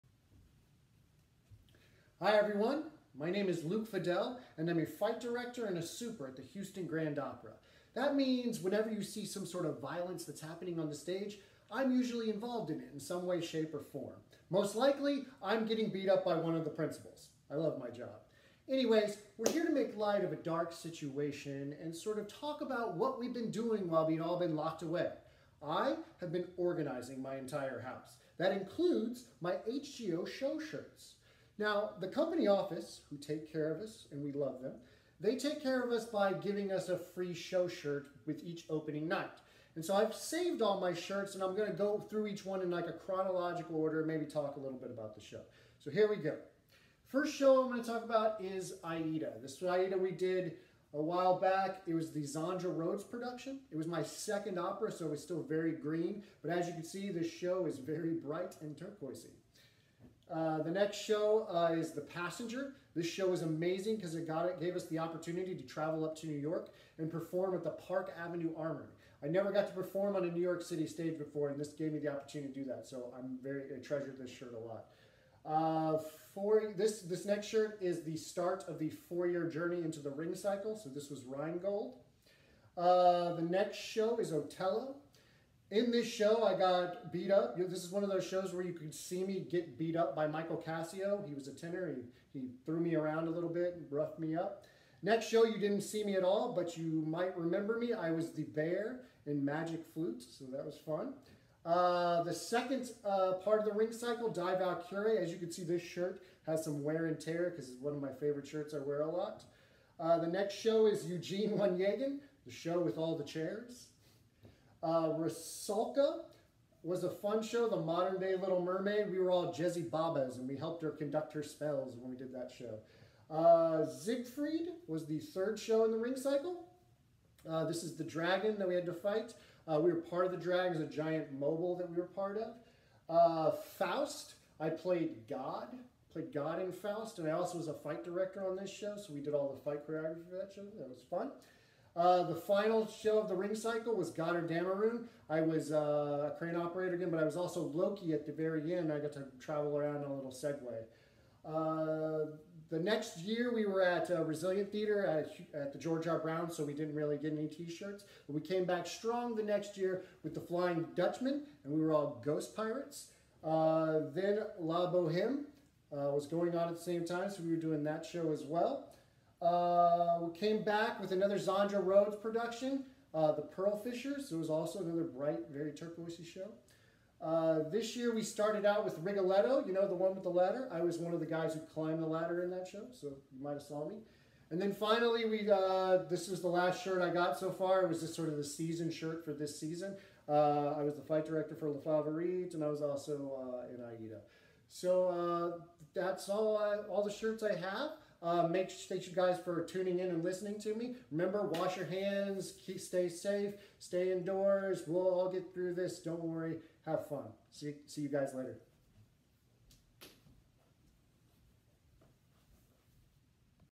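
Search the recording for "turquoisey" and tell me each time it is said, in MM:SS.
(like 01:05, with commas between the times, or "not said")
00:58, 02:55.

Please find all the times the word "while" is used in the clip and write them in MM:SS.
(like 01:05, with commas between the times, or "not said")
00:23, 00:51.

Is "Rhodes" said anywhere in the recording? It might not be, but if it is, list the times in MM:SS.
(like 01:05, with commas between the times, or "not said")
00:52, 02:51.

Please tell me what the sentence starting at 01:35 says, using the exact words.
Next show, you didn't see me at all, but you might remember me.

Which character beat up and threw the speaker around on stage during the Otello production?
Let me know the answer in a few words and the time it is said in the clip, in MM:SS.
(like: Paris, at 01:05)
Michael Cassio, at 01:30.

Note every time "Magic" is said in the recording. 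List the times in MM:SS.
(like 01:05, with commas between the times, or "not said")
01:39.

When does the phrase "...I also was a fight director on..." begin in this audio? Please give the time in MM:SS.
02:17.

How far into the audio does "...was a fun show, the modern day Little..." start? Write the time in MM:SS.
01:56.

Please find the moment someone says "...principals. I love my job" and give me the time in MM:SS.
00:16.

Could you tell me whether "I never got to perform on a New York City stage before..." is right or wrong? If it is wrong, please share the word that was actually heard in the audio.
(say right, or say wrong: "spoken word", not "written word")
right.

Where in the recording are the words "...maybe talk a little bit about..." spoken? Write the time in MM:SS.
00:44.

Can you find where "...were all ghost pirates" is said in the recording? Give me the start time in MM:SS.
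02:41.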